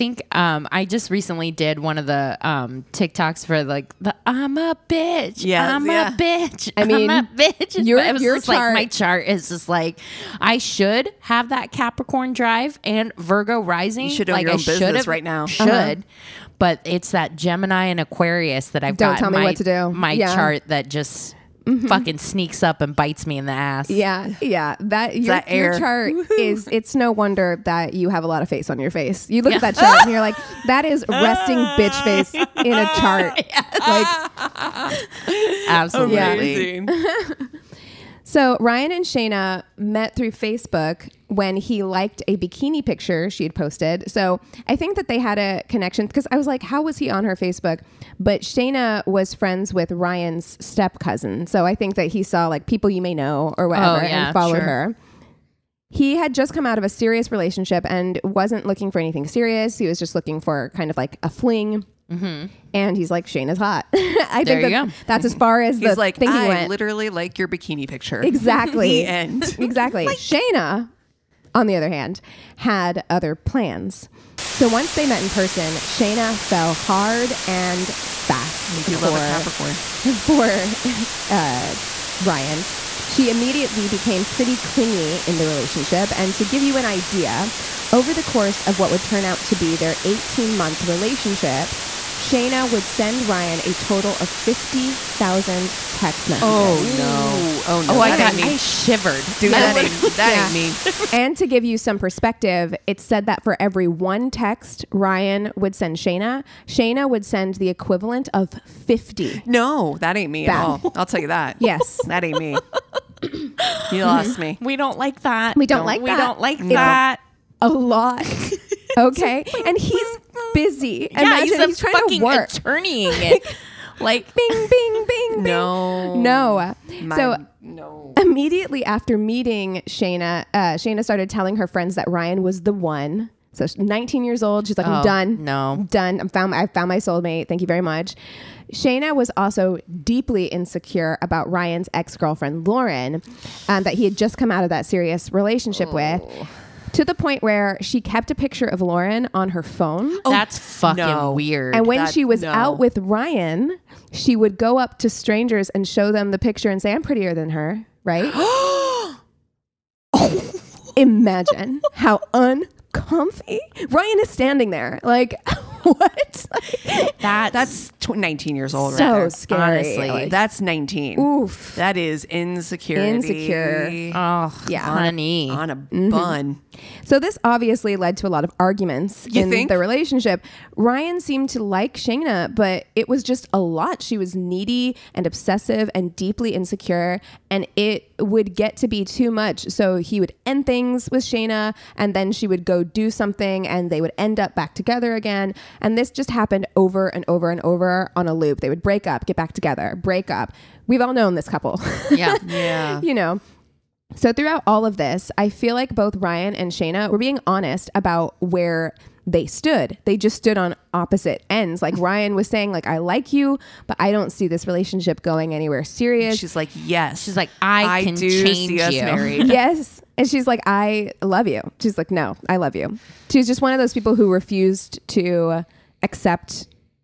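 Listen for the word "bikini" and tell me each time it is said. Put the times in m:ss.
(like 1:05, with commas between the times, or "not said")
0:42, 1:07.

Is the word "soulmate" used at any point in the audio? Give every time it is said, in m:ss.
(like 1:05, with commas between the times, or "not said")
2:16.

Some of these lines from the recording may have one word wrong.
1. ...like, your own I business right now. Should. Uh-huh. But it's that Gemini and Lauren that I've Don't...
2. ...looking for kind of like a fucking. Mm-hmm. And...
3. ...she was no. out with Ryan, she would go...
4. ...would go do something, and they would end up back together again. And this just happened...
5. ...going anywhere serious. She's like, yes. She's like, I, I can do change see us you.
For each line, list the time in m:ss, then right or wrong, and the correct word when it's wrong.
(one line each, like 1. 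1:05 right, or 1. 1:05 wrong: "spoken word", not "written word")
1. 0:14 wrong: "Aquarius", not "Lauren"
2. 1:00 wrong: "fling", not "fucking"
3. 2:32 right
4. 3:12 right
5. 3:35 right.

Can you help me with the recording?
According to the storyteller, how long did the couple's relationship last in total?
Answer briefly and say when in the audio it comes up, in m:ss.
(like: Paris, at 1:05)
18 months, at 1:30.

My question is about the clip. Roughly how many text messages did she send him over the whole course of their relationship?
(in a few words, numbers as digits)
50,000.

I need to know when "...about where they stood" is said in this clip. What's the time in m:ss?
3:27.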